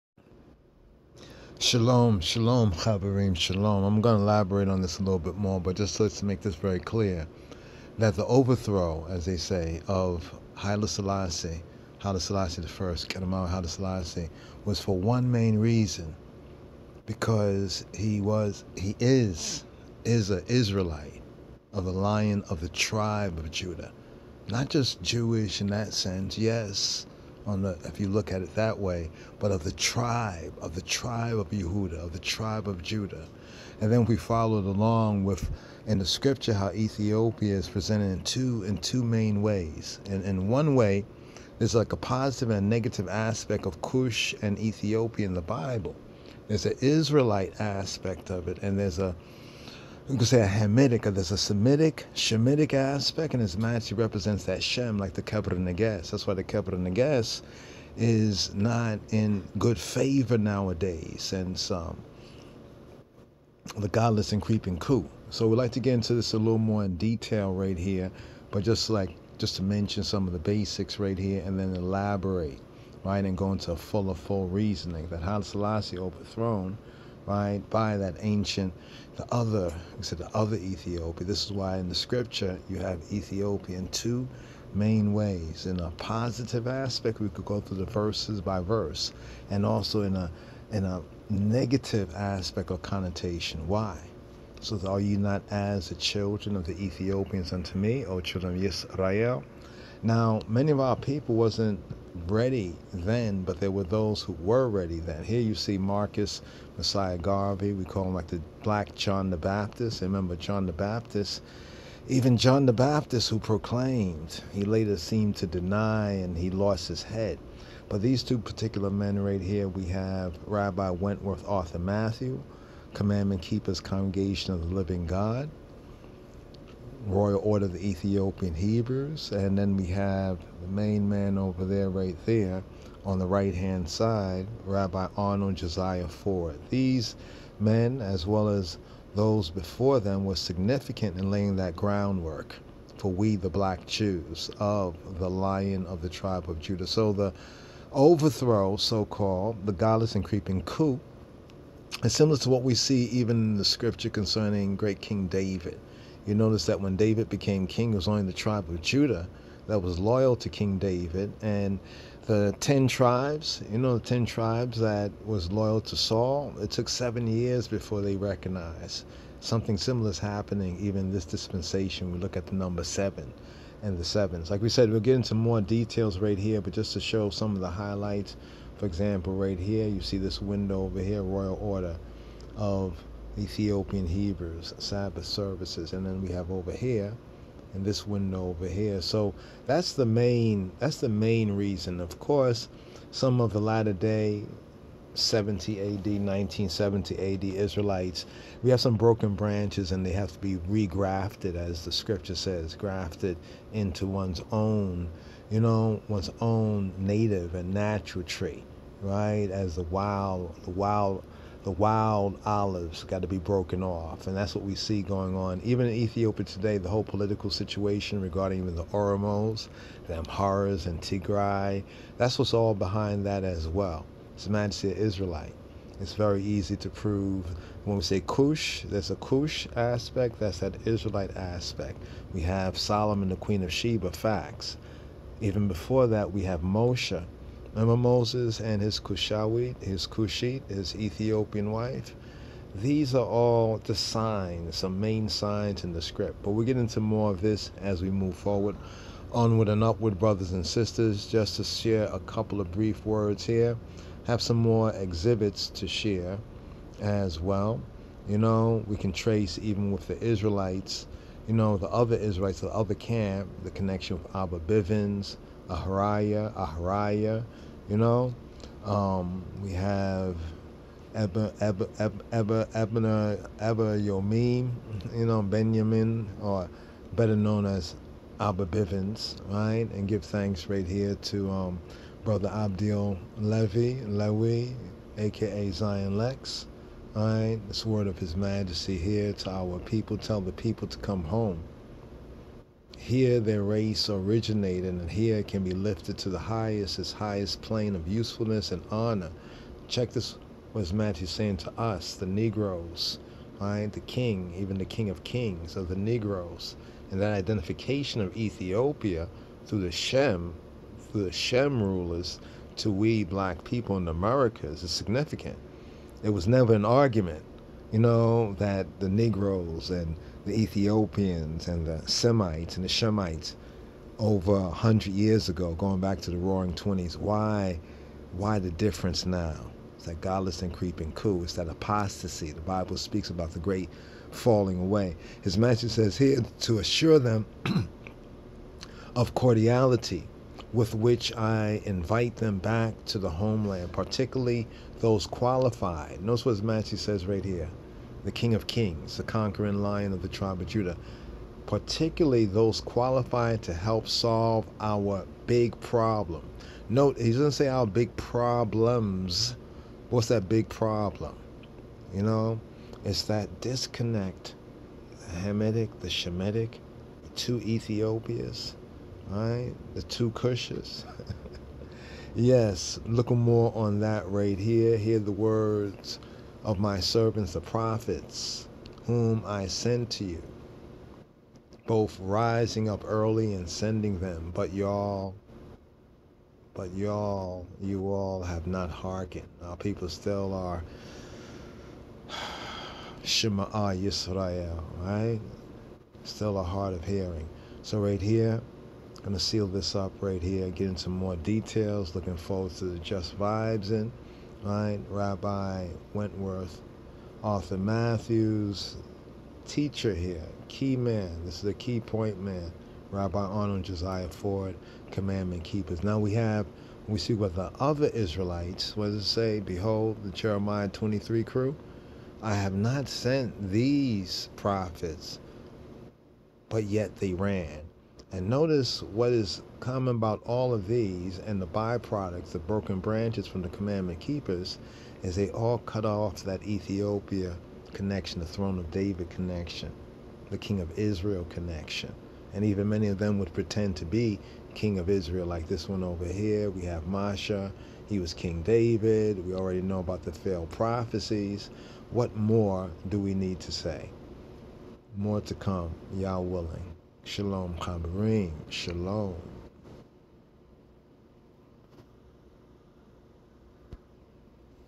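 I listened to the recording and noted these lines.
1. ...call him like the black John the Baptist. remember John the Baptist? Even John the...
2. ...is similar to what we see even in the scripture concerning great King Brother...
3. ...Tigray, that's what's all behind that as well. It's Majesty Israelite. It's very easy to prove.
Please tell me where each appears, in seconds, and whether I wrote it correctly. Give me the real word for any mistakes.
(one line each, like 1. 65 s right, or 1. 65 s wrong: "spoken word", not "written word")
1. 107 s right
2. 152 s wrong: "David", not "Brother"
3. 221 s right.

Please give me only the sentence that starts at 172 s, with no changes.
We look at the number seven and the sevens.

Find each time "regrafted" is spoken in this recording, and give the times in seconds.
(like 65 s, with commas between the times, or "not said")
200 s.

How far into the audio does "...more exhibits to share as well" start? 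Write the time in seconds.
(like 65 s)
254 s.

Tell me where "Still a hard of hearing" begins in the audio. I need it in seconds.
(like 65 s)
396 s.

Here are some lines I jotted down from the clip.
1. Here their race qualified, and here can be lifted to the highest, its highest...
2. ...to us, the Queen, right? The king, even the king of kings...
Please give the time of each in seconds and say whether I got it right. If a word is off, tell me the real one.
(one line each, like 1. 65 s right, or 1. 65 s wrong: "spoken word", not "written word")
1. 292 s wrong: "originated", not "qualified"
2. 301 s wrong: "Negroes", not "Queen".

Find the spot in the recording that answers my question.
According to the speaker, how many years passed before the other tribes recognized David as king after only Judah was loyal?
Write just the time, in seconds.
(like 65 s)
166 s.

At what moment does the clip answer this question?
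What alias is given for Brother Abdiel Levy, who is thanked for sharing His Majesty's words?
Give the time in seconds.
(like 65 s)
285 s.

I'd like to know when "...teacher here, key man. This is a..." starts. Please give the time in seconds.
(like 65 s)
409 s.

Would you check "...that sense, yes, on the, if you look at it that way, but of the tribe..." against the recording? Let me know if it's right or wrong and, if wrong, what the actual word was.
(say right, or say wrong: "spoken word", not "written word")
right.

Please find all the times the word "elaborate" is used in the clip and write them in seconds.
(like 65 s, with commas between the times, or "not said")
4 s, 71 s.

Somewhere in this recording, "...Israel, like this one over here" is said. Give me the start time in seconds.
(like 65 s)
445 s.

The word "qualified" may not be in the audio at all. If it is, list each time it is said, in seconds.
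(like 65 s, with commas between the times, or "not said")
345 s, 352 s.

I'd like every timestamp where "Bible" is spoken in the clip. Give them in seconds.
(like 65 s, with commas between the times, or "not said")
45 s, 332 s.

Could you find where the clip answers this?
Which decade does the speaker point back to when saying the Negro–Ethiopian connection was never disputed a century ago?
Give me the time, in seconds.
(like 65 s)
326 s.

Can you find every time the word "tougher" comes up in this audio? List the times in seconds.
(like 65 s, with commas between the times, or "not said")
not said.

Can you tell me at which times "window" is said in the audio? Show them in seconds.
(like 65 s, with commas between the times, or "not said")
180 s, 188 s.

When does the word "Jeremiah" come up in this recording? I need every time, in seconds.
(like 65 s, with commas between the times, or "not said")
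420 s.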